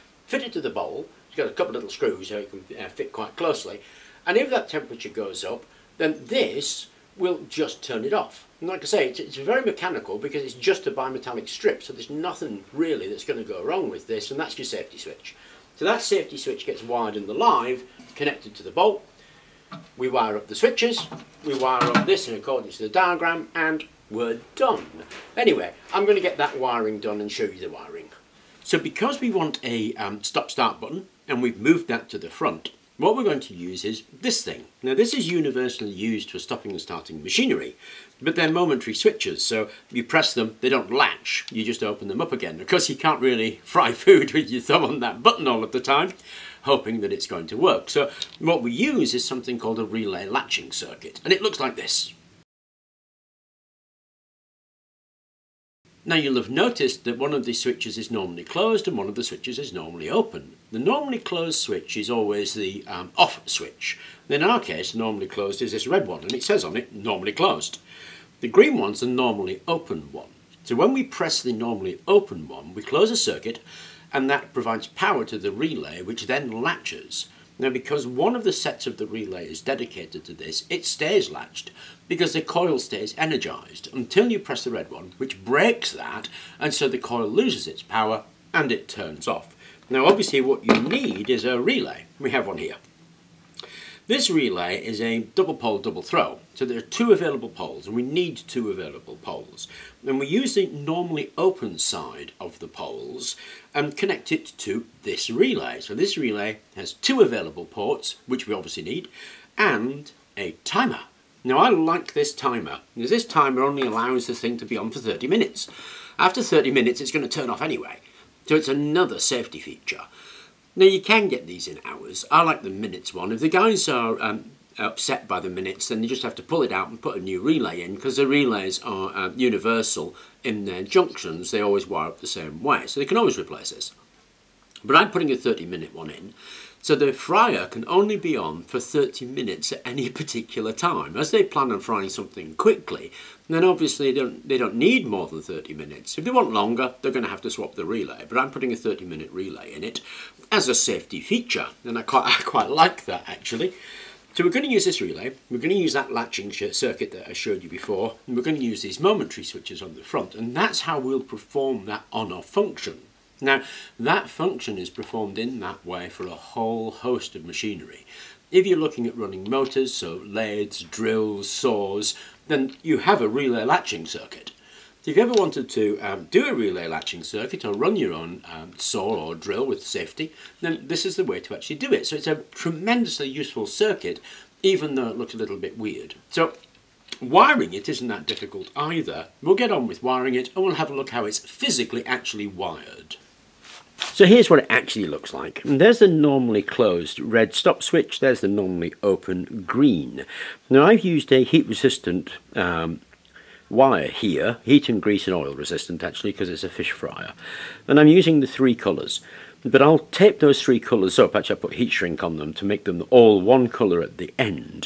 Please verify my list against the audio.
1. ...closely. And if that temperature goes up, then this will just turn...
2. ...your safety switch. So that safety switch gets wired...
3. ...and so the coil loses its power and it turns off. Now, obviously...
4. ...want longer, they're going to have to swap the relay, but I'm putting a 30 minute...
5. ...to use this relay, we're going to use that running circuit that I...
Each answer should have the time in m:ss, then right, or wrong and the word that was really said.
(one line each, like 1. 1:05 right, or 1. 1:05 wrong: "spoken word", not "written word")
1. 0:03 right
2. 0:14 right
3. 1:26 right
4. 2:26 right
5. 2:34 wrong: "latching", not "running".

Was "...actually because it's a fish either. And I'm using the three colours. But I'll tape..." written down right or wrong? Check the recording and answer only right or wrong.
wrong.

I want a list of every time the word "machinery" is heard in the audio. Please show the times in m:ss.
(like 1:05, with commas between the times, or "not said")
0:37, 2:47.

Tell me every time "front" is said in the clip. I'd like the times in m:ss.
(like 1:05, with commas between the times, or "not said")
0:32, 2:40.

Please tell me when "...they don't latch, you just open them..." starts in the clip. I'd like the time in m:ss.
0:40.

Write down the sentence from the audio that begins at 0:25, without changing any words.
Anyway, I'm going to get that wiring done and show you the wiring.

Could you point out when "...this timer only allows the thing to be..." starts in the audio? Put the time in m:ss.
1:53.